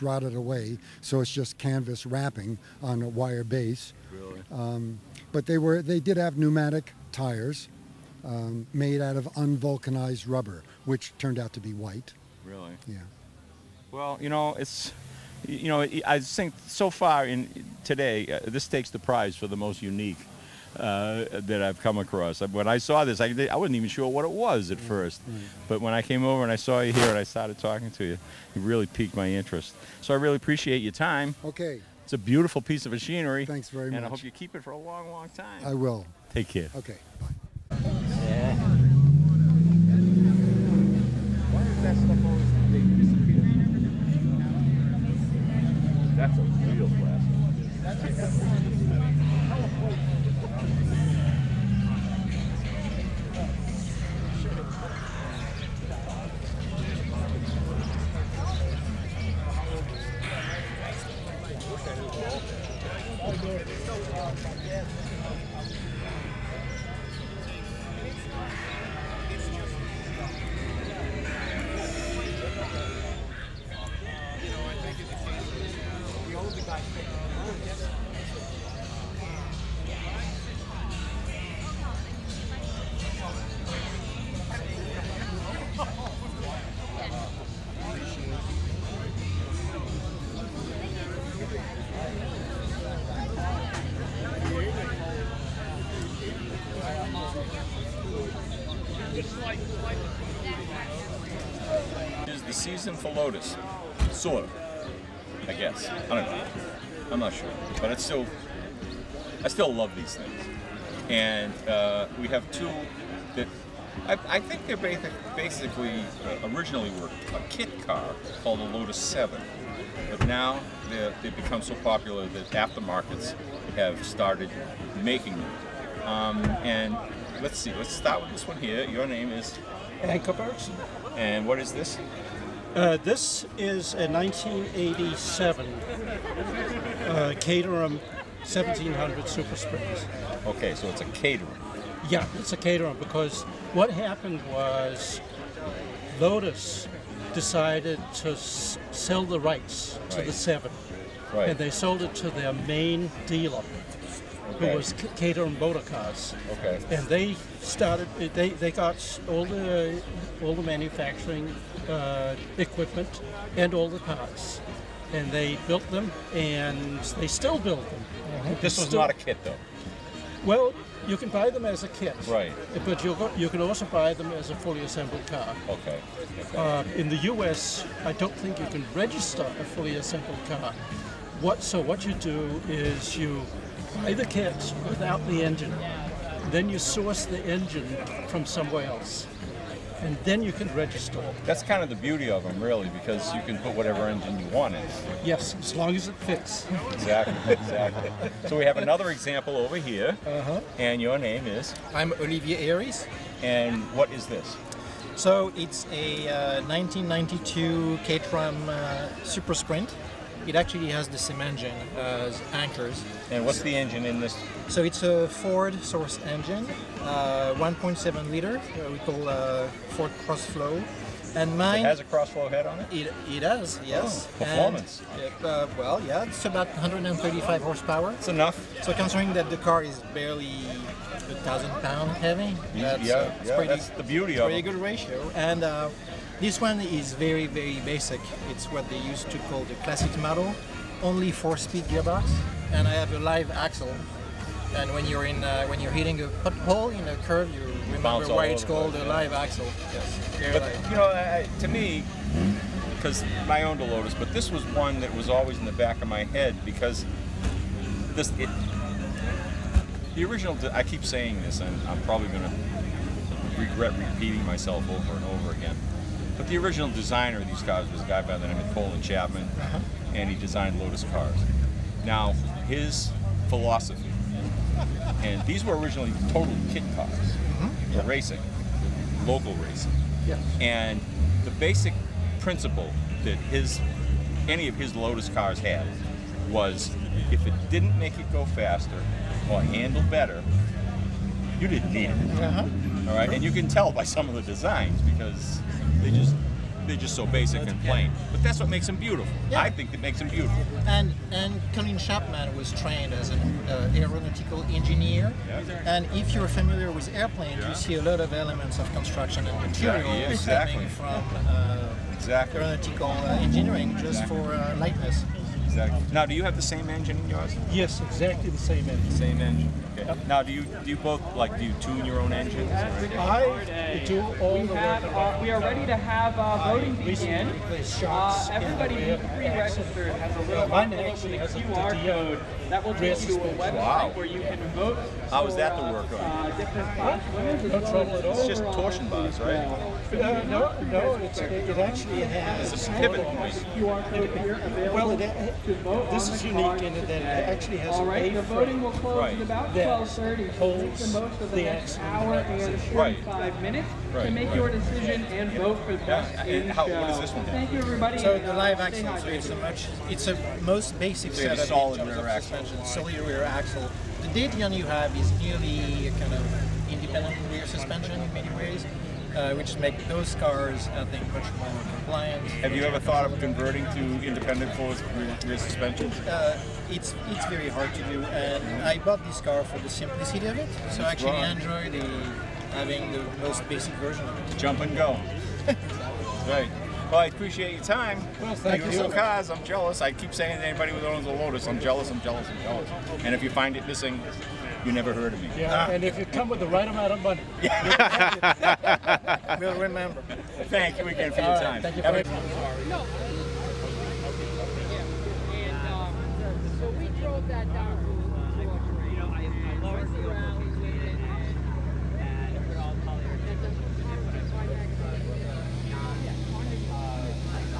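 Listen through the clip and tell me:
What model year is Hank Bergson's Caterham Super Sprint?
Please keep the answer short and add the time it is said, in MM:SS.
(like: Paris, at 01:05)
1987, at 02:14.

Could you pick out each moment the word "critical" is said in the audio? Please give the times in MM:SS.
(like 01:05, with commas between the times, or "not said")
not said.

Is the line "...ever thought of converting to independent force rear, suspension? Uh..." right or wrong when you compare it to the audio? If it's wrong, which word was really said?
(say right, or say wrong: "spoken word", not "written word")
right.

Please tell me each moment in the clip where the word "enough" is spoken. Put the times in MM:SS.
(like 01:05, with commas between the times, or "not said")
03:48.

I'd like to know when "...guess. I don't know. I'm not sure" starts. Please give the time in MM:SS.
01:45.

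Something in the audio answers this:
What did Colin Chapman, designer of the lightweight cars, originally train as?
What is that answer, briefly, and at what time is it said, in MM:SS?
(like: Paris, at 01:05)
aeronautical engineer, at 05:03.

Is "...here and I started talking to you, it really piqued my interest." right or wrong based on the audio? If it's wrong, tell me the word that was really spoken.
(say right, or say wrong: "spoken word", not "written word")
right.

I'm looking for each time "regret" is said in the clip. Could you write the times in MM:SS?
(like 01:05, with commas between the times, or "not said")
04:23.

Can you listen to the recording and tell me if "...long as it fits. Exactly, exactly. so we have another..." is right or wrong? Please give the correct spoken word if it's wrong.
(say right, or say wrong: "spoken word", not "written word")
right.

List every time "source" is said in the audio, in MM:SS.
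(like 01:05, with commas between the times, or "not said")
03:06, 03:35.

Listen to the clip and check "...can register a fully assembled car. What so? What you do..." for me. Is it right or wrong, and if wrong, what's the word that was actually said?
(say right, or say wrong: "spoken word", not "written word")
right.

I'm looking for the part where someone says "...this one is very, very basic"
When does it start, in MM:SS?
03:56.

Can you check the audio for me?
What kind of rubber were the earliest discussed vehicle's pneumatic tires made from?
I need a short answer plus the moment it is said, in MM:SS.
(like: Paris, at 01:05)
unvulcanized rubber, at 00:09.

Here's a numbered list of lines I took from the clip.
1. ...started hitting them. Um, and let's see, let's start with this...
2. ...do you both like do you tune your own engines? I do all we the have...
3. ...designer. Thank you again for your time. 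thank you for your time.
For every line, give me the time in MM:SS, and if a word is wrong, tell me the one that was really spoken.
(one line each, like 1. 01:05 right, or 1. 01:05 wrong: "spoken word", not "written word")
1. 02:04 wrong: "making", not "hitting"
2. 05:20 right
3. 06:39 wrong: "remember", not "designer".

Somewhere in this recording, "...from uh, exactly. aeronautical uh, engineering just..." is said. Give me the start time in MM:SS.
05:10.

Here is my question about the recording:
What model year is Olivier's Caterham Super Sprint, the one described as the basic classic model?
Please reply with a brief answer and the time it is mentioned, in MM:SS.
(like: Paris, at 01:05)
1992, at 03:26.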